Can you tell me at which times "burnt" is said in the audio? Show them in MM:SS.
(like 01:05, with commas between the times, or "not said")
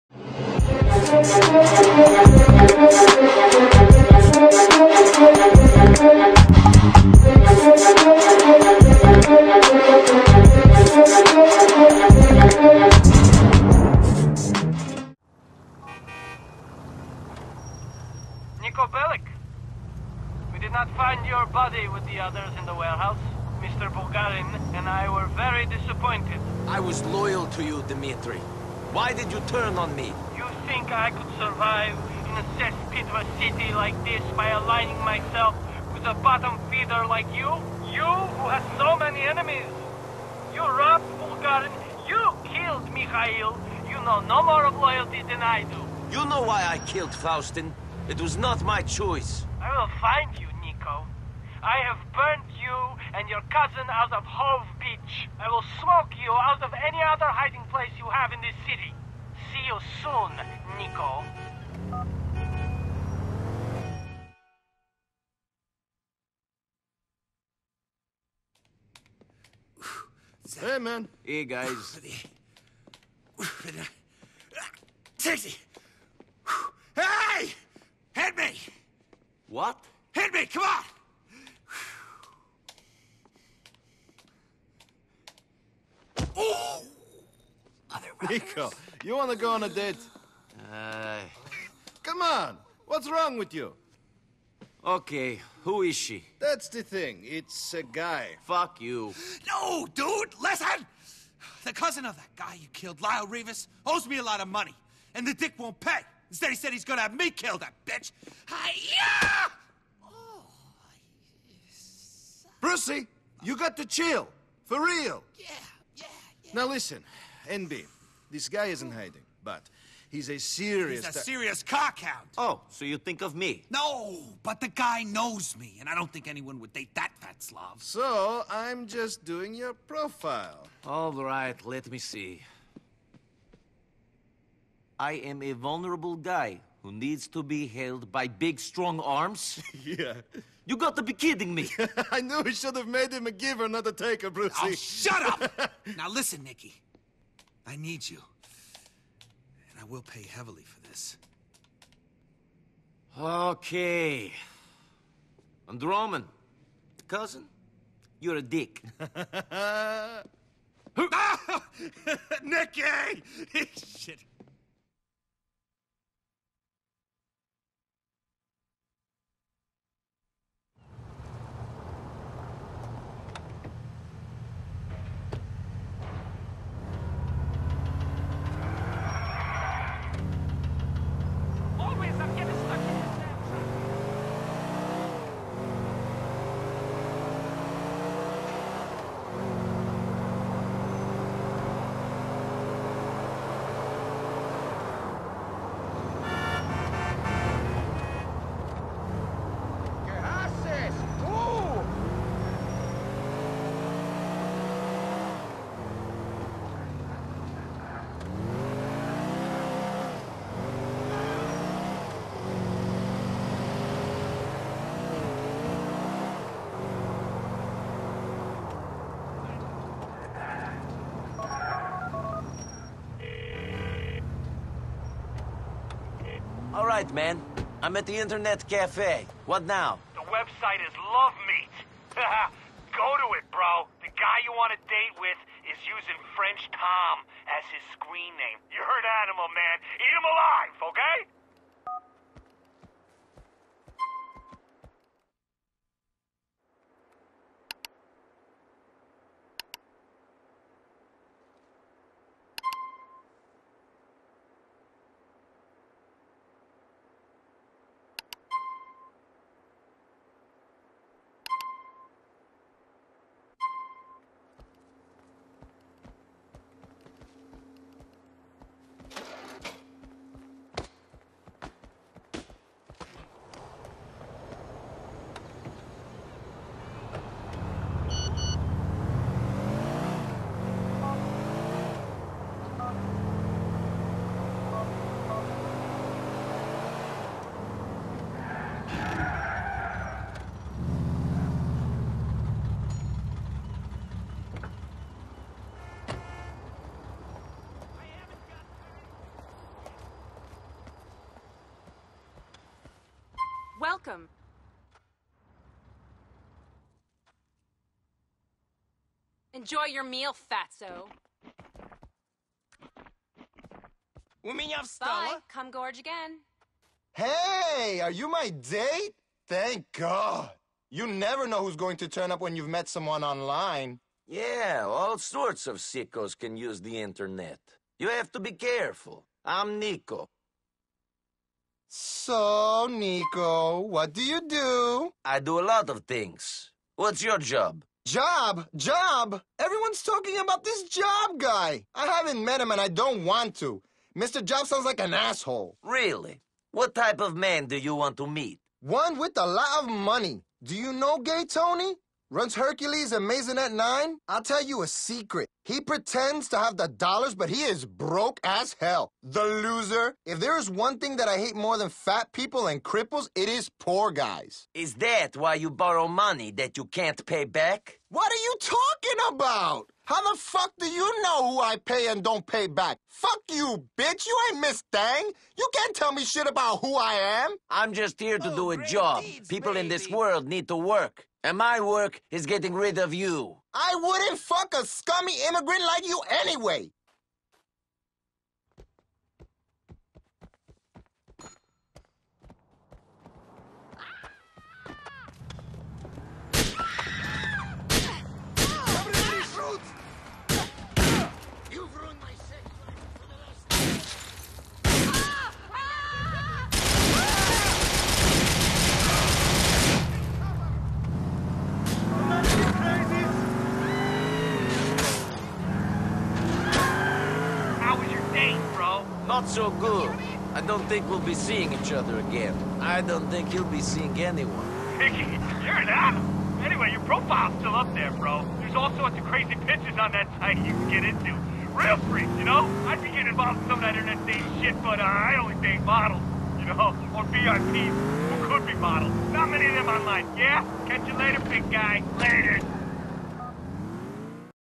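00:52.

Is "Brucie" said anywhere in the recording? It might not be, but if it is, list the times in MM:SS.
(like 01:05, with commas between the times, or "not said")
01:52, 02:24.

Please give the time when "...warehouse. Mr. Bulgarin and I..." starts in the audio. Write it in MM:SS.
00:22.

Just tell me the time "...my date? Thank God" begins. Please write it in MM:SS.
05:18.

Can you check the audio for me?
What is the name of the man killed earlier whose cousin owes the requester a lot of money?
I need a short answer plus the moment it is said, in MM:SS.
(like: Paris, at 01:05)
Lyle Rivas, at 01:43.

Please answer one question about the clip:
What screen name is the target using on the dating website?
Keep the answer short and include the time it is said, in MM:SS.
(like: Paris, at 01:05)
French Tom, at 03:56.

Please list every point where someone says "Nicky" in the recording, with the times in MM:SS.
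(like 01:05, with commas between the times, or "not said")
02:26, 02:42.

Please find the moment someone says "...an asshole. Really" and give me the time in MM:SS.
05:45.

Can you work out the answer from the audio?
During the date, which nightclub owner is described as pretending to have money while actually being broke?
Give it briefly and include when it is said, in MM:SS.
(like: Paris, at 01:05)
Gay Tony, at 05:51.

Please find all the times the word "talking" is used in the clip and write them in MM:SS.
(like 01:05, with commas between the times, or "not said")
05:40, 06:08.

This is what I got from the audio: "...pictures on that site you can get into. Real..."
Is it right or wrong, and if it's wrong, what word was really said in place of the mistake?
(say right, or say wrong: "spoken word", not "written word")
right.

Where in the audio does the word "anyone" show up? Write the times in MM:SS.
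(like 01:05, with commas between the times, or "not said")
02:06, 07:04.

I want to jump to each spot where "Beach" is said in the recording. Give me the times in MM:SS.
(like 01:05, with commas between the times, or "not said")
00:54.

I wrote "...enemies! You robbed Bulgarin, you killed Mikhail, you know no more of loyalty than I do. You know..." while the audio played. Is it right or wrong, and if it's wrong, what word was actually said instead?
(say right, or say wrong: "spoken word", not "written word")
right.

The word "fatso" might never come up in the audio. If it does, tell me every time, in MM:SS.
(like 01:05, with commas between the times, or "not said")
05:10.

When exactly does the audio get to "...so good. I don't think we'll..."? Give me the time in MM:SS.
06:59.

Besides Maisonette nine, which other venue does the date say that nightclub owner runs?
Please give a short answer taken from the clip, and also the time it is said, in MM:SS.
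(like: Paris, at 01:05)
Hercules, at 05:52.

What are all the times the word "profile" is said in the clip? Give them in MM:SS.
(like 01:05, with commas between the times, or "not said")
02:09, 07:07.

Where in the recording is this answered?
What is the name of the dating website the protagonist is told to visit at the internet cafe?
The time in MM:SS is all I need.
03:50.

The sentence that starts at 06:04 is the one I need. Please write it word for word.
Is that why you borrow money that you can't pay back?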